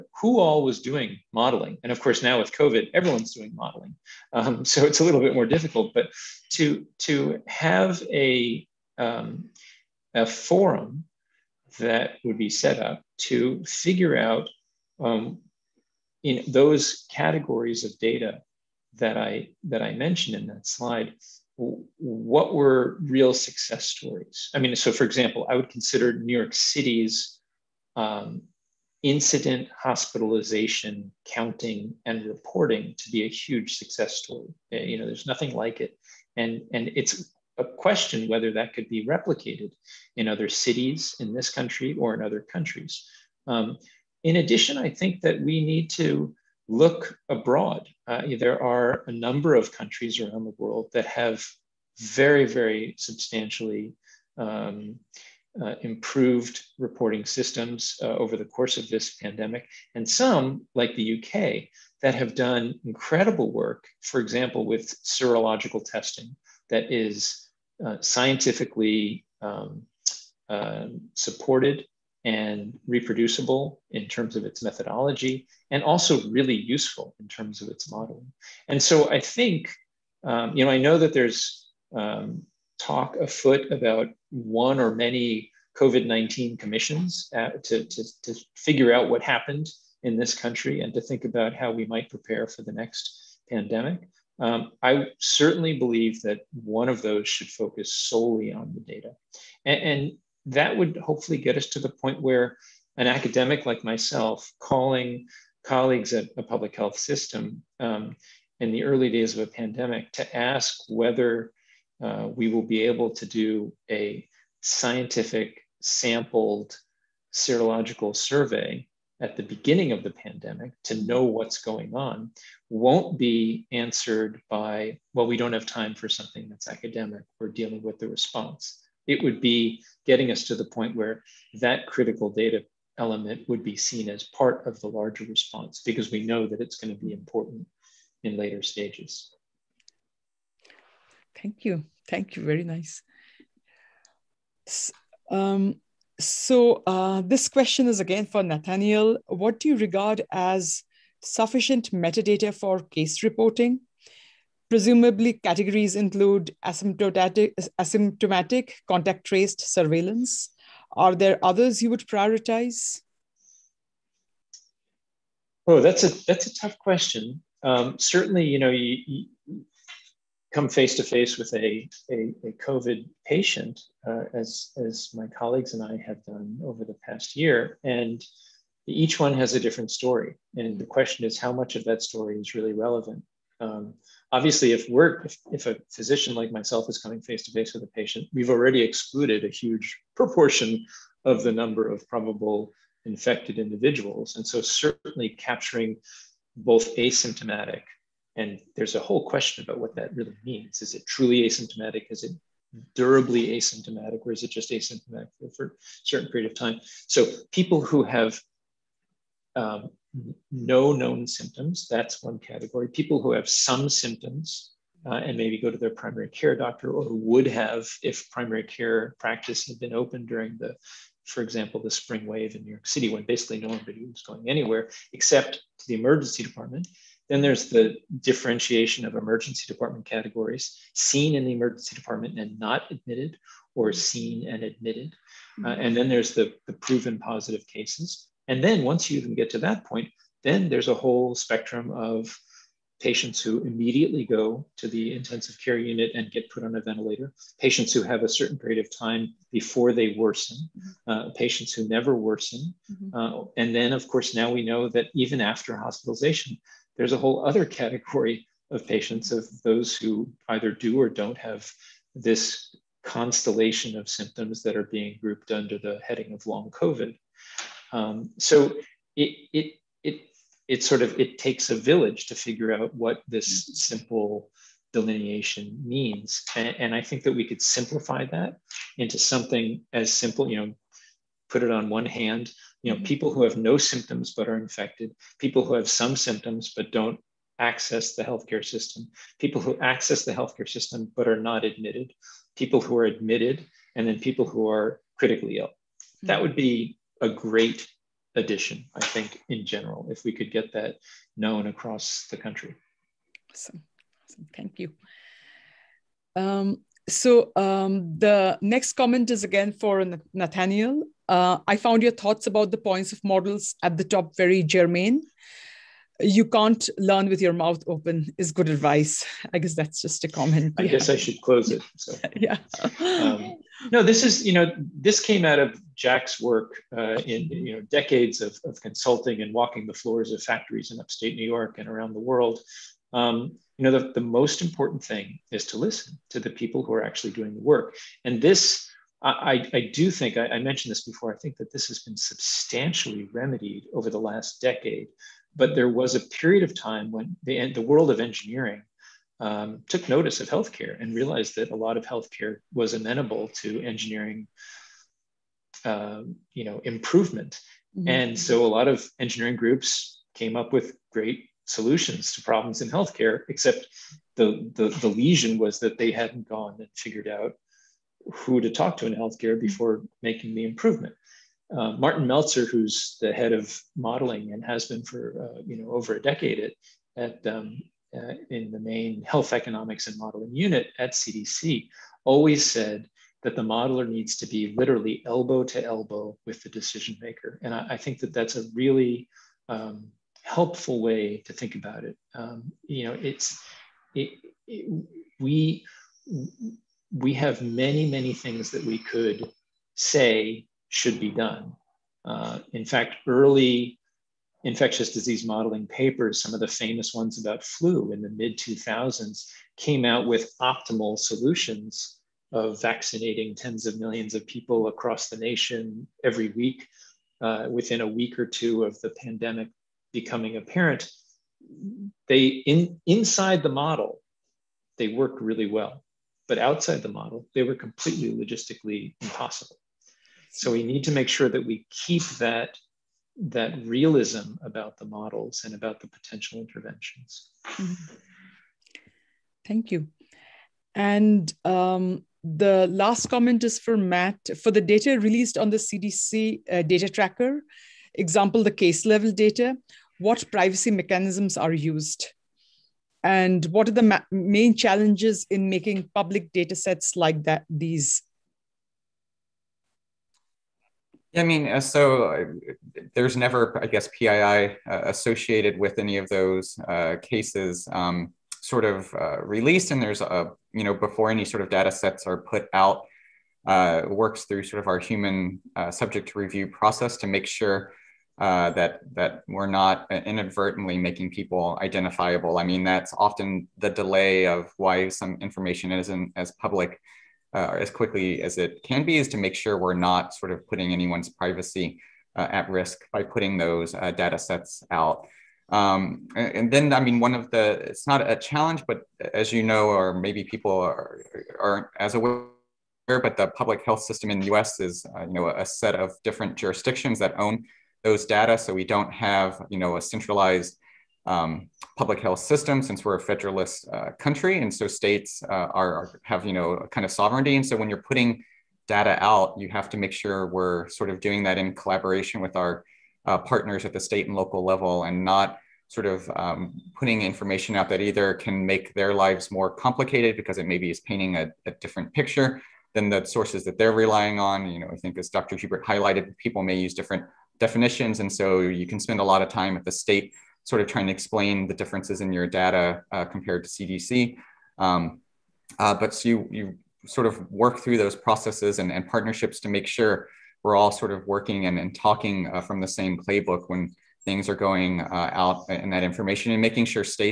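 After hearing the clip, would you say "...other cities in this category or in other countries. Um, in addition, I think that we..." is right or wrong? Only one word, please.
wrong.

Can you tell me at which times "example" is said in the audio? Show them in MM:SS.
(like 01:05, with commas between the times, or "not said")
00:25, 01:04, 03:41, 07:28.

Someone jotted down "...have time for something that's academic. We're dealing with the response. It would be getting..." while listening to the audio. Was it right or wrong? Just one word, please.
right.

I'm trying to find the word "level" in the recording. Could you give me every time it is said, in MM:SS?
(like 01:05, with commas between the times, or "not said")
07:29, 08:44.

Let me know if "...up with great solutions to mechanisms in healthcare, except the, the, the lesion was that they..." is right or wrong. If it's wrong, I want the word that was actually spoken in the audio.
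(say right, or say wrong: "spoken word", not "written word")
wrong: "problems", not "mechanisms".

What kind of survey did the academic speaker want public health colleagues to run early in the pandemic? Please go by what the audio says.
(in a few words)
scientific sampled serological survey.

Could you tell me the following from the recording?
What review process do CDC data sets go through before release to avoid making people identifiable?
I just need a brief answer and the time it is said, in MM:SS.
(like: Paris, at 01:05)
human subject review, at 07:54.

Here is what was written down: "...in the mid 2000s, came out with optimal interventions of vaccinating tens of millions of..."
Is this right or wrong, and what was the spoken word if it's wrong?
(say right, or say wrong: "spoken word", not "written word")
wrong: "solutions", not "interventions".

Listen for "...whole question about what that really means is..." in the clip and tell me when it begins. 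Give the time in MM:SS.
03:18.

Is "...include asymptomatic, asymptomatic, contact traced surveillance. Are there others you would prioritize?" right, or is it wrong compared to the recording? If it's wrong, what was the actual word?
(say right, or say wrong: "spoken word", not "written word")
right.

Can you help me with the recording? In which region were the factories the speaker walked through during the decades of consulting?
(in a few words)
upstate New York.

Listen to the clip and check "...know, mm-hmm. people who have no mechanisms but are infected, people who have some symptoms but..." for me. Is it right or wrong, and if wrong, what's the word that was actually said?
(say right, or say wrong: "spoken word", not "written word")
wrong: "symptoms", not "mechanisms".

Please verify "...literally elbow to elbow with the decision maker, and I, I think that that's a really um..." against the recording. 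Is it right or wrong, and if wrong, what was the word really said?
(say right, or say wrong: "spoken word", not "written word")
right.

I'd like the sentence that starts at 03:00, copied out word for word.
And the question is, how much of that story is really relevant?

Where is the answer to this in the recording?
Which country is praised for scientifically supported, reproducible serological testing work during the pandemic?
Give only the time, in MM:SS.
01:00.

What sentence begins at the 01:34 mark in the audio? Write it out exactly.
Um, I certainly believe that one of those should focus solely on the data.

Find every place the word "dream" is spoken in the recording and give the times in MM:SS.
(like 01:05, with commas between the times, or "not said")
not said.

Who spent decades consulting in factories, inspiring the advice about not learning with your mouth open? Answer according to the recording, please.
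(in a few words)
Jack.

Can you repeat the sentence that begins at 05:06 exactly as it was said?
Um, so um, the next comment is again for Nathaniel.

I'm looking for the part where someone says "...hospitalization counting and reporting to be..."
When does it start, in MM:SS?
00:29.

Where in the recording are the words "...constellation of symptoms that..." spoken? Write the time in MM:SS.
04:23.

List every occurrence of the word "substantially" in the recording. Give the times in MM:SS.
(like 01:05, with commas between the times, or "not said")
00:52, 05:42.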